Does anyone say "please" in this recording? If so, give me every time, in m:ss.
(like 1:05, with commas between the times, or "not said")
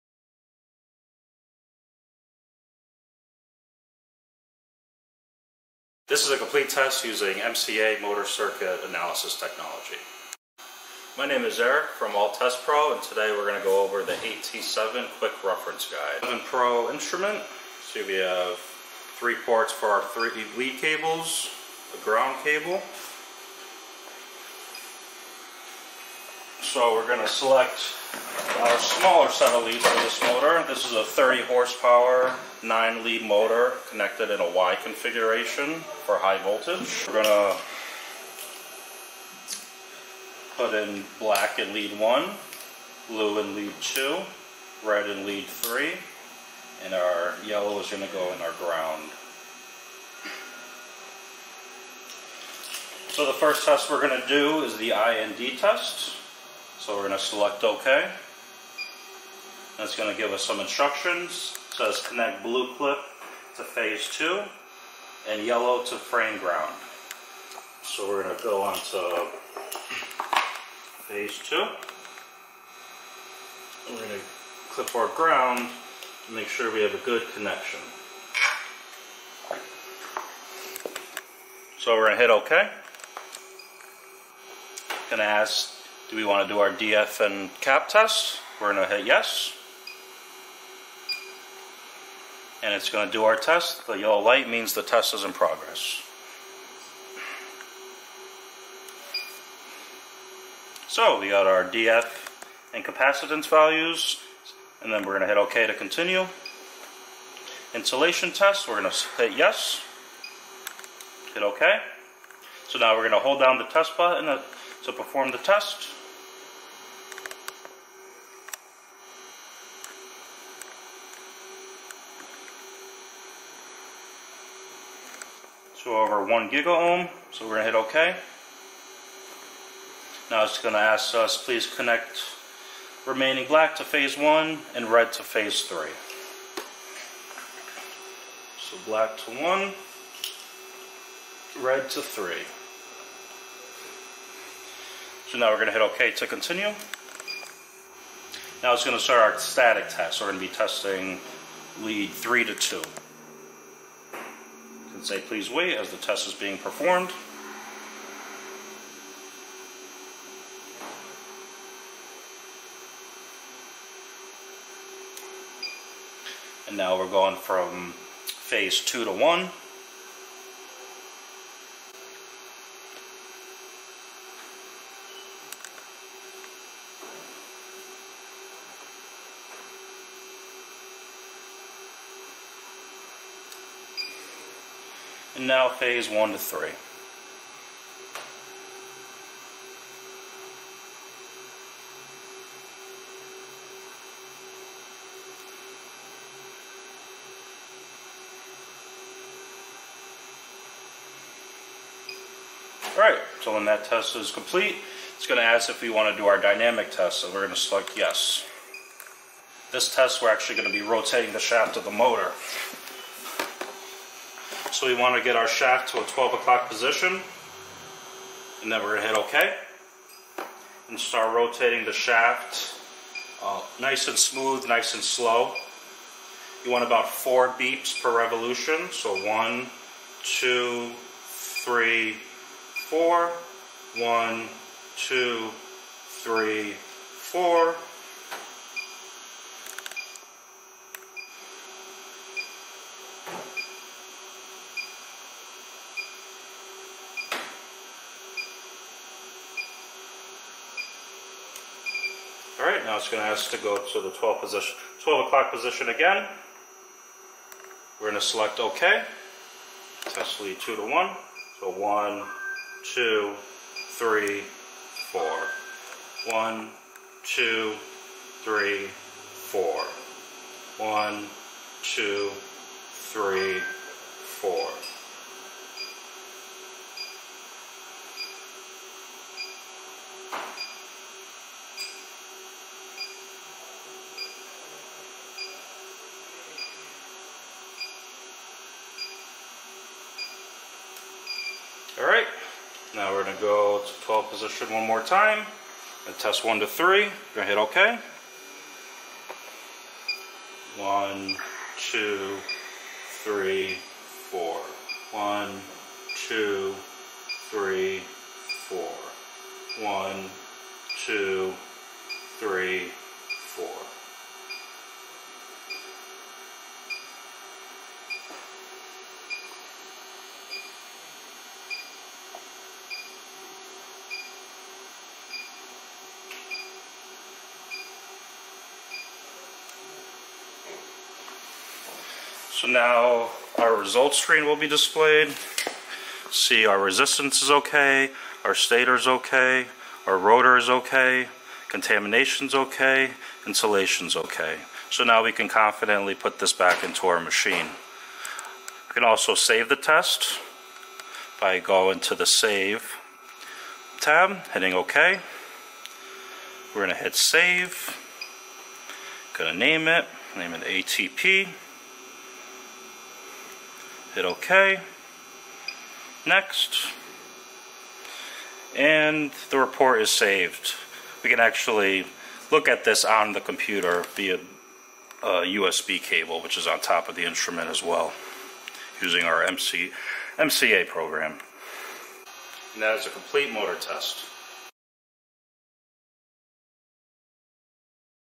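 2:11, 2:35.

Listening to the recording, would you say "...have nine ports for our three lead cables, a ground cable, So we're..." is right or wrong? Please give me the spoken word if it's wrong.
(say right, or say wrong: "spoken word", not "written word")
wrong: "three", not "nine".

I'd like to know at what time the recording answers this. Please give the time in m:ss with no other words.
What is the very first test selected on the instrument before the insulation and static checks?
0:54.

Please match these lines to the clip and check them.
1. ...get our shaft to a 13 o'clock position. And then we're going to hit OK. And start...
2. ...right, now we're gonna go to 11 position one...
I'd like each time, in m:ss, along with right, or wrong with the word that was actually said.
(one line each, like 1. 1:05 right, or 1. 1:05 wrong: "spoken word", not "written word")
1. 3:35 wrong: "12", not "13"
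2. 4:52 wrong: "12", not "11".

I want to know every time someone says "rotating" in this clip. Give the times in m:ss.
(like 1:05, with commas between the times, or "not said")
3:30, 3:41.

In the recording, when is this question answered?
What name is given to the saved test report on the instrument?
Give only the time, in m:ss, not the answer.
6:00.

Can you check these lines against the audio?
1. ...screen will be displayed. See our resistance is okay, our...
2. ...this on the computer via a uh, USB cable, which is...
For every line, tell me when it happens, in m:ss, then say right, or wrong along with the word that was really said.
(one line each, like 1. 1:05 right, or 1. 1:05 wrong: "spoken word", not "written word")
1. 5:34 right
2. 6:12 right.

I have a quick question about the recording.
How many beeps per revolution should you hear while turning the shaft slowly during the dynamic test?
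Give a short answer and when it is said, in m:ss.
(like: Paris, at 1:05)
4, at 3:47.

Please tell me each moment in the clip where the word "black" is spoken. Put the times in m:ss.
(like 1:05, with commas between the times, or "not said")
0:41, 2:13, 2:18.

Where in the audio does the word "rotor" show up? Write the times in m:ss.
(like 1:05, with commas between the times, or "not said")
5:40.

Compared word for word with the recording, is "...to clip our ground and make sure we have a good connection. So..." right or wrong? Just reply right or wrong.
right.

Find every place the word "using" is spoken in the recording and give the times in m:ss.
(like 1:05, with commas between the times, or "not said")
0:07, 6:19.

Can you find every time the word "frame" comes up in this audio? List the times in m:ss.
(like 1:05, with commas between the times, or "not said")
1:05.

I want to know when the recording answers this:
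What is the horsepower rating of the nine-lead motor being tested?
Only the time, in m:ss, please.
0:31.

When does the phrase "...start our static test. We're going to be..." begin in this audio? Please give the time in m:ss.
2:29.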